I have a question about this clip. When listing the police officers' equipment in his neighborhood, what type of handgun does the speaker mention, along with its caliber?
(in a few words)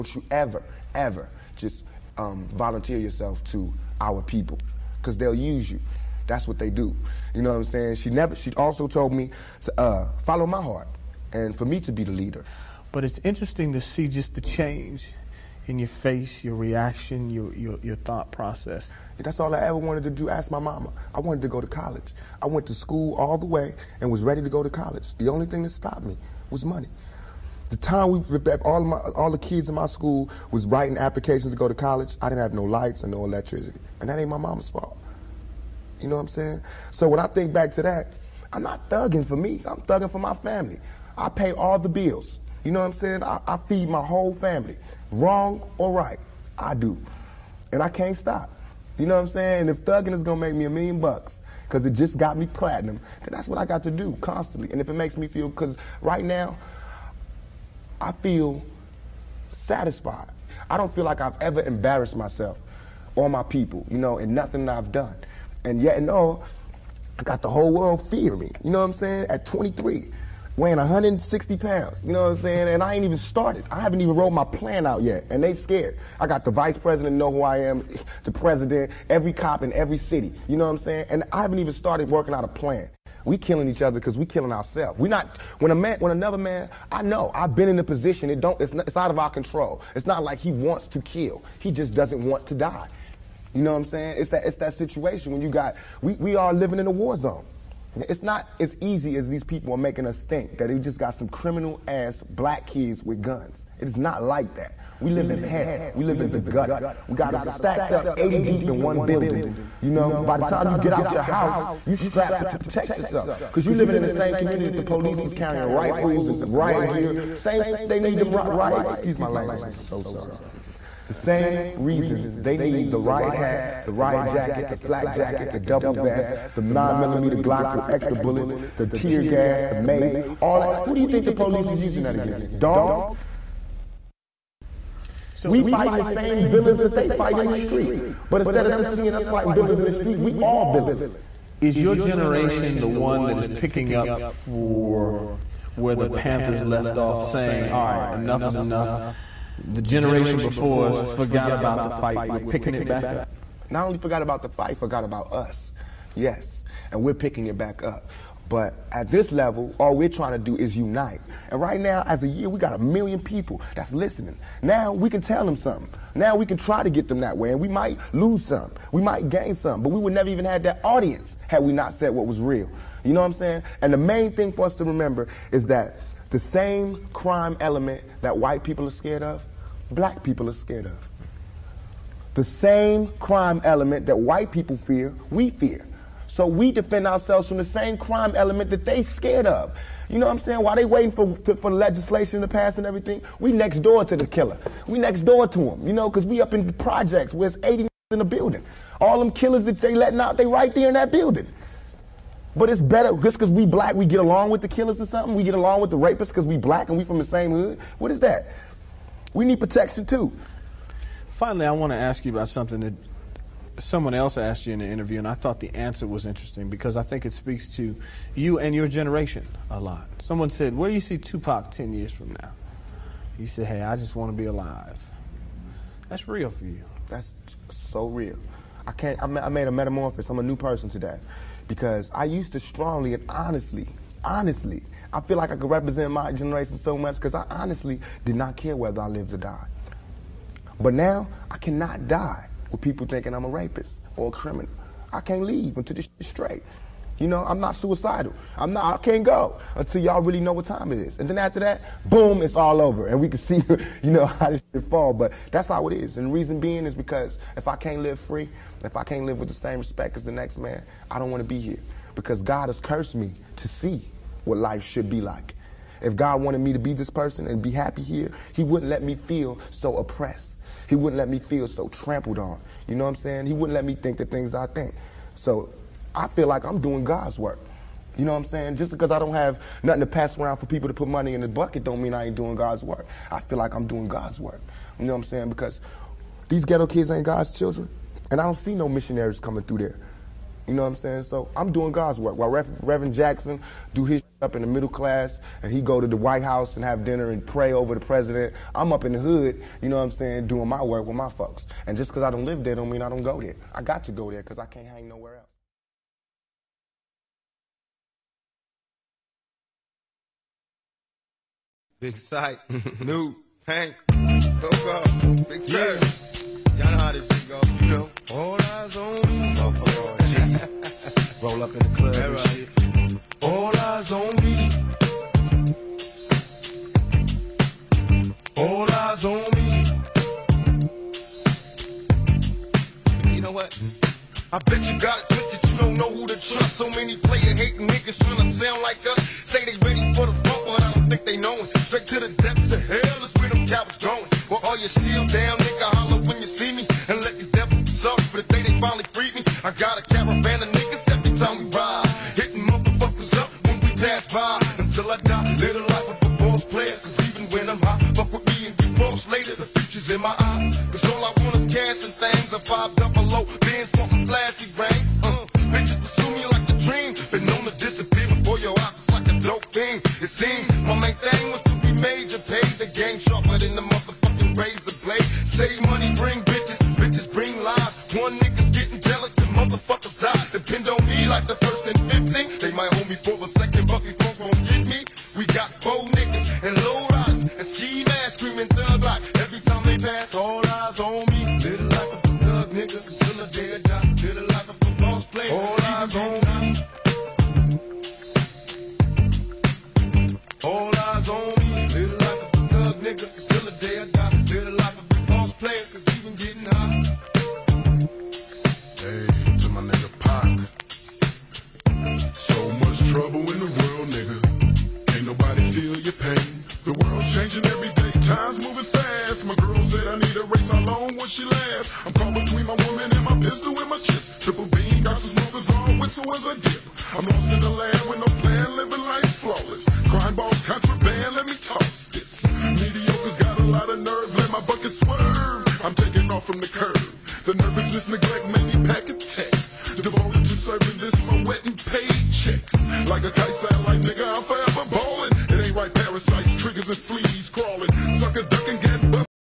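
9mm Glocks.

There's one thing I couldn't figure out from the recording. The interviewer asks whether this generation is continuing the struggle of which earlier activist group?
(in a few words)
The Panthers.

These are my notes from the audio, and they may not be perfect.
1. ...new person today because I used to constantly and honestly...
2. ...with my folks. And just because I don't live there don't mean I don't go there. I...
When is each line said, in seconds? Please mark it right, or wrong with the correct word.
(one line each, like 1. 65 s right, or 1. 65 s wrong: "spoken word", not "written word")
1. 230 s wrong: "strongly", not "constantly"
2. 301 s right.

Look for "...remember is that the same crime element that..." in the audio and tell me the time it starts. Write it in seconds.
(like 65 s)
174 s.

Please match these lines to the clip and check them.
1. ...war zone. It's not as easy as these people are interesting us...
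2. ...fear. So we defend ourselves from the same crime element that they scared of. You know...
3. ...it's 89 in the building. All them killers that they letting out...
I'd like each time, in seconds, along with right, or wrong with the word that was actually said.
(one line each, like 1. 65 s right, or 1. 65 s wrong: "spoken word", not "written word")
1. 96 s wrong: "making", not "interesting"
2. 185 s right
3. 197 s wrong: "80", not "89".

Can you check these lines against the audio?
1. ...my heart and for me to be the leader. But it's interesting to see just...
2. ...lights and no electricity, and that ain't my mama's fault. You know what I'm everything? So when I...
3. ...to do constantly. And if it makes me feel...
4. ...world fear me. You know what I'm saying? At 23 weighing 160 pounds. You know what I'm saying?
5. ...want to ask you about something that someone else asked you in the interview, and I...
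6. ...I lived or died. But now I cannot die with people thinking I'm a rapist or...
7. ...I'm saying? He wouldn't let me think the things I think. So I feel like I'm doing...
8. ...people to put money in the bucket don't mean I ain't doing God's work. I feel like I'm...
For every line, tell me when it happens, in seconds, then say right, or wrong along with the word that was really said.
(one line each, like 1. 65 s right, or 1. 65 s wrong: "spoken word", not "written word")
1. 10 s right
2. 32 s wrong: "saying", not "everything"
3. 53 s right
4. 67 s right
5. 211 s right
6. 239 s right
7. 273 s right
8. 280 s right.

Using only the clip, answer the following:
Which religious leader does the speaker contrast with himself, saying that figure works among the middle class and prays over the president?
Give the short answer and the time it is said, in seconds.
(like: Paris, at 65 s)
Reverend Jackson, at 292 s.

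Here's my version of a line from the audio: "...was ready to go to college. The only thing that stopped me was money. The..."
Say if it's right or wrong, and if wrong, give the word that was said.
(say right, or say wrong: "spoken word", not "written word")
right.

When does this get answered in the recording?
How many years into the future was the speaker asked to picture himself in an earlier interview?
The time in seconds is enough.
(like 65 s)
221 s.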